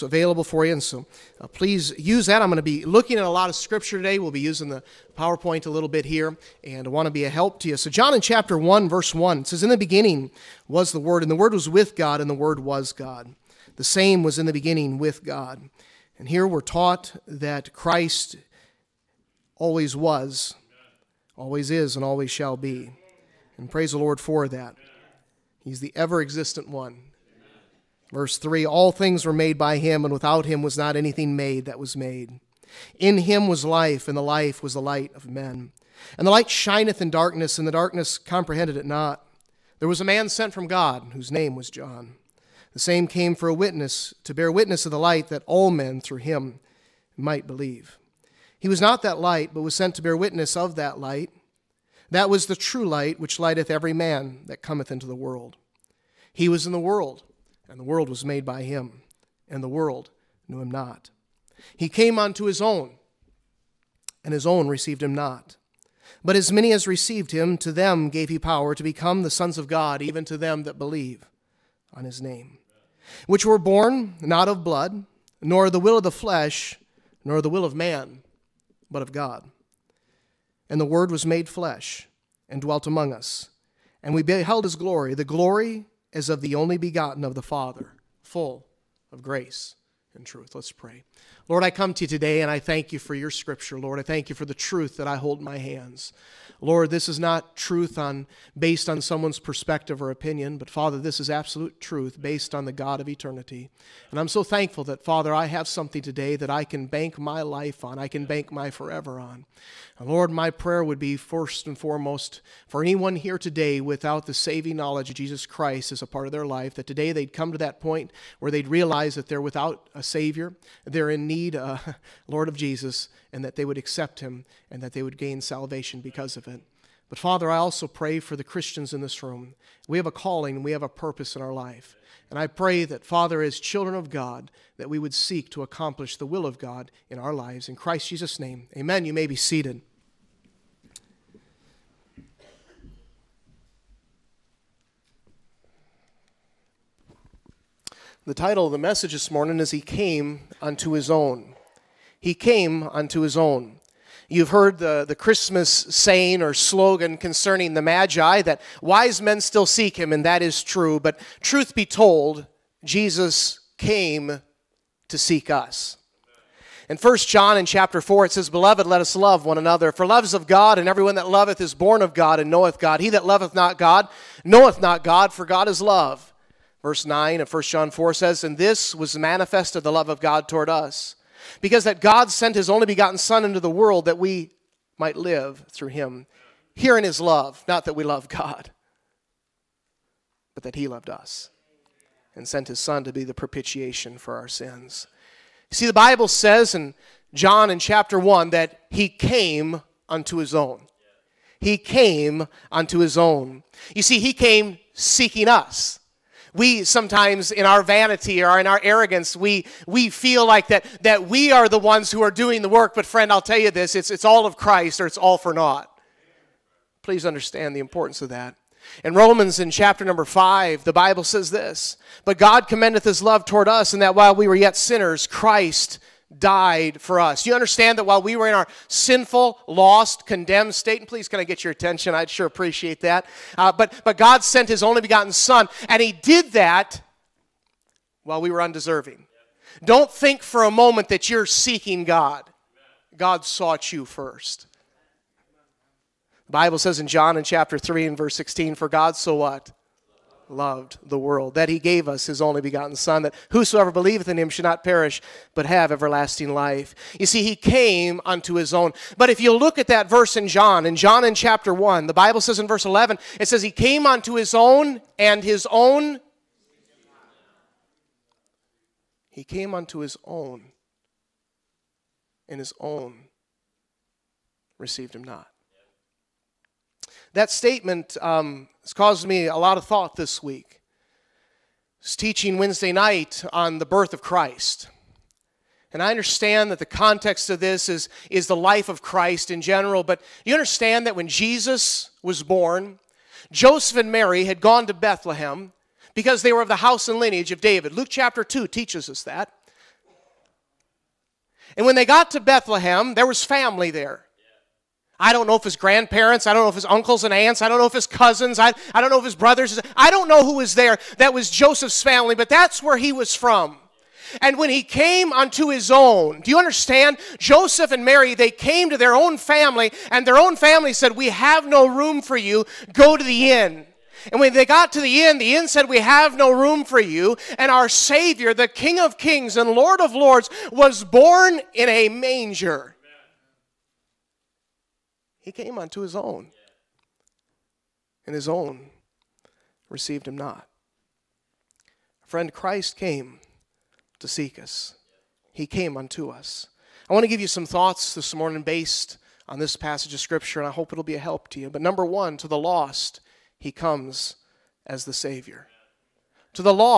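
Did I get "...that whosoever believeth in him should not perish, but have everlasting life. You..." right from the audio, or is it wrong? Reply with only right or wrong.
right.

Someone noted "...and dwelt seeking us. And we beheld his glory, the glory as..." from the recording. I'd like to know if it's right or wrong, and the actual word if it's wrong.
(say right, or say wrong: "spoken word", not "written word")
wrong: "among", not "seeking".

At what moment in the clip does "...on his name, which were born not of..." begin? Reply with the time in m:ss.
1:11.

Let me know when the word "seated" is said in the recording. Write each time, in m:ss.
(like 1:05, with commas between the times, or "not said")
2:19.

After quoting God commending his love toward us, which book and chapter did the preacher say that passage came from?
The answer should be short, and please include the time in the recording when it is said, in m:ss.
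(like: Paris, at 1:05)
Romans chapter 5, at 3:39.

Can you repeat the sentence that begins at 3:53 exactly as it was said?
Uh, but, but God sent His only begotten Son, and He did that while we were undeserving.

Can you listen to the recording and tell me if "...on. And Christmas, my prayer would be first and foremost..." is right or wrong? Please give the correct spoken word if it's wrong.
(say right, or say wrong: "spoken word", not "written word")
wrong: "Lord", not "Christmas".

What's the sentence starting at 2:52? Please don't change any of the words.
He that loveth not God knoweth not God, for God is love.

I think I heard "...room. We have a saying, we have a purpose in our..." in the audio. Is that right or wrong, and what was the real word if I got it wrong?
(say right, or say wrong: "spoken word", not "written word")
wrong: "calling", not "saying".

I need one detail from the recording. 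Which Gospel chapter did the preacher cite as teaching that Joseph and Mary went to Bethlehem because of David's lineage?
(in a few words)
Luke chapter 2.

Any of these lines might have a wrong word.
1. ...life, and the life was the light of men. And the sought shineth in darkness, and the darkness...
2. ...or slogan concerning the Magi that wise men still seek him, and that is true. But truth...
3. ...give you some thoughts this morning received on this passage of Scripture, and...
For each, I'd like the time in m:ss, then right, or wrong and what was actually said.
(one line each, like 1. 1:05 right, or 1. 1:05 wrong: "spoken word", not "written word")
1. 0:33 wrong: "light", not "sought"
2. 2:36 right
3. 5:47 wrong: "based", not "received".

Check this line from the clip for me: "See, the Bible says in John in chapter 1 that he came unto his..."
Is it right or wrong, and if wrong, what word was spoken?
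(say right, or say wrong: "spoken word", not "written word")
right.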